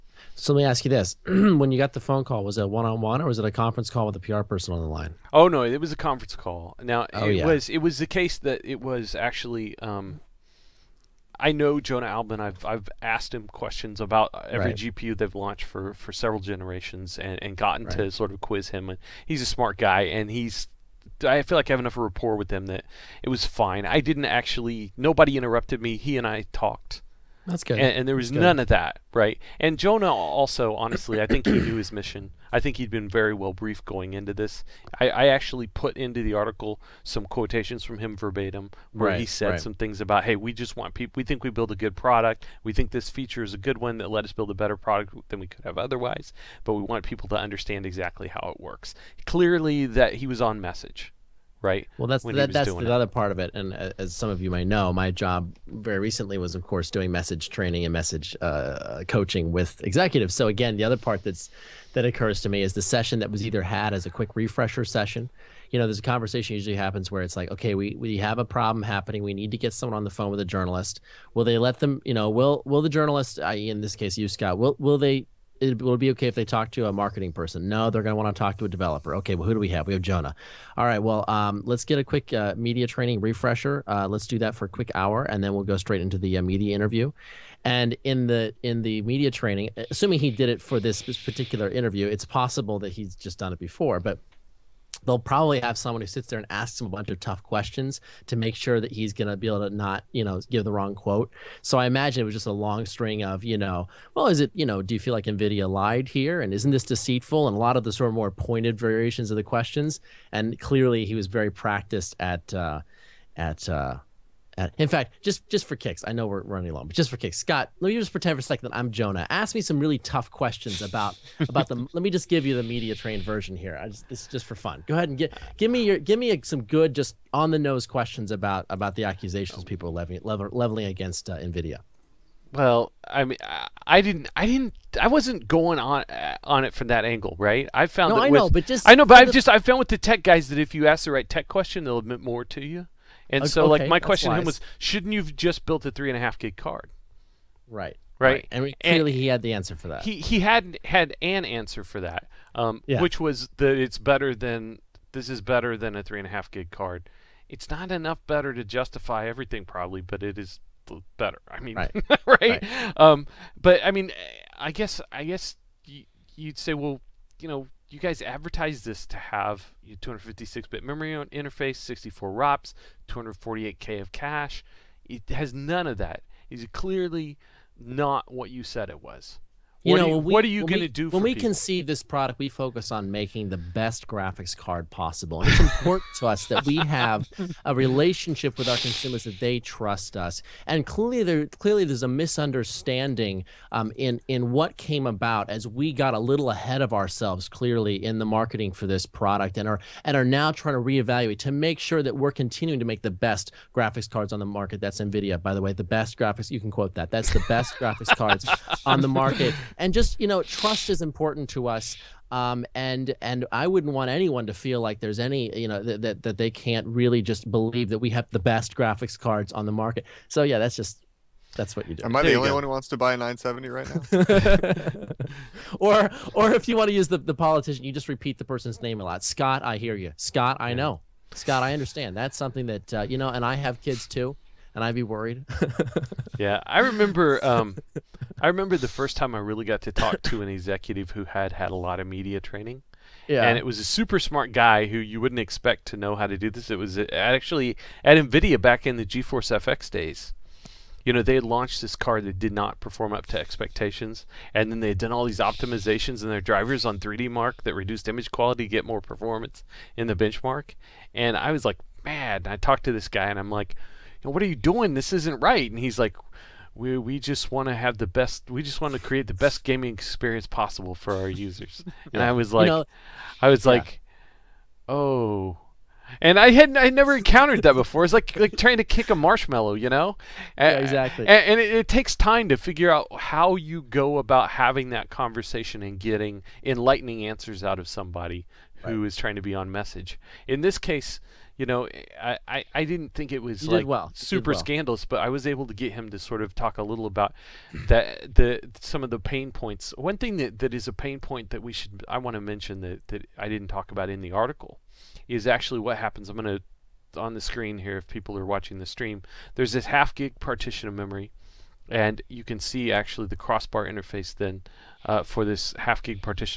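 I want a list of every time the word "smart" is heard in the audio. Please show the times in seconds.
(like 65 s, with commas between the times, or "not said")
19 s, 244 s.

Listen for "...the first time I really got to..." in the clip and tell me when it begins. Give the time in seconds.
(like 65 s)
238 s.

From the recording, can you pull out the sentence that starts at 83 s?
Uh, let's do that for a quick hour, and then we'll go straight into the uh, media interview.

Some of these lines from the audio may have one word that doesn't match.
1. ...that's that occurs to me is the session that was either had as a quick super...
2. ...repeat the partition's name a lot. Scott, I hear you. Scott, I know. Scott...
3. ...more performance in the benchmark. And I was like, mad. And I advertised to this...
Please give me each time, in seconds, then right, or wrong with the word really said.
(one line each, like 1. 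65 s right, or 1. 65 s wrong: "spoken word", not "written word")
1. 61 s wrong: "refresher", not "super"
2. 228 s wrong: "person", not "partition"
3. 258 s wrong: "talked", not "advertised".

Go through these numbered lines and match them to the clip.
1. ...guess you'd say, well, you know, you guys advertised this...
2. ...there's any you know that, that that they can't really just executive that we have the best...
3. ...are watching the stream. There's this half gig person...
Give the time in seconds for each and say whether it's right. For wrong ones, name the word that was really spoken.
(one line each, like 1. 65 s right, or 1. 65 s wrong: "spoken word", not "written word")
1. 165 s right
2. 215 s wrong: "believe", not "executive"
3. 308 s wrong: "partition", not "person".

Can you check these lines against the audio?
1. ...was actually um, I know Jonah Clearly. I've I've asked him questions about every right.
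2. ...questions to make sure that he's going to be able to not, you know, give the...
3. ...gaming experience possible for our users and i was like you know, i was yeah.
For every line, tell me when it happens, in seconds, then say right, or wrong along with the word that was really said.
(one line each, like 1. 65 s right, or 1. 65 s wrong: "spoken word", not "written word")
1. 8 s wrong: "Alben", not "Clearly"
2. 97 s right
3. 269 s right.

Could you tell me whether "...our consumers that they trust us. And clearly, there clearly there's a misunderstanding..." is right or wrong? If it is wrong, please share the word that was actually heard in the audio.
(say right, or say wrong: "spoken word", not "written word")
right.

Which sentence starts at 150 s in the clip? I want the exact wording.
He he had had an answer for that, um, yeah.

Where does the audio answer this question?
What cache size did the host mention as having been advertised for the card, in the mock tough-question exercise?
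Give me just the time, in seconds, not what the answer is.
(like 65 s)
173 s.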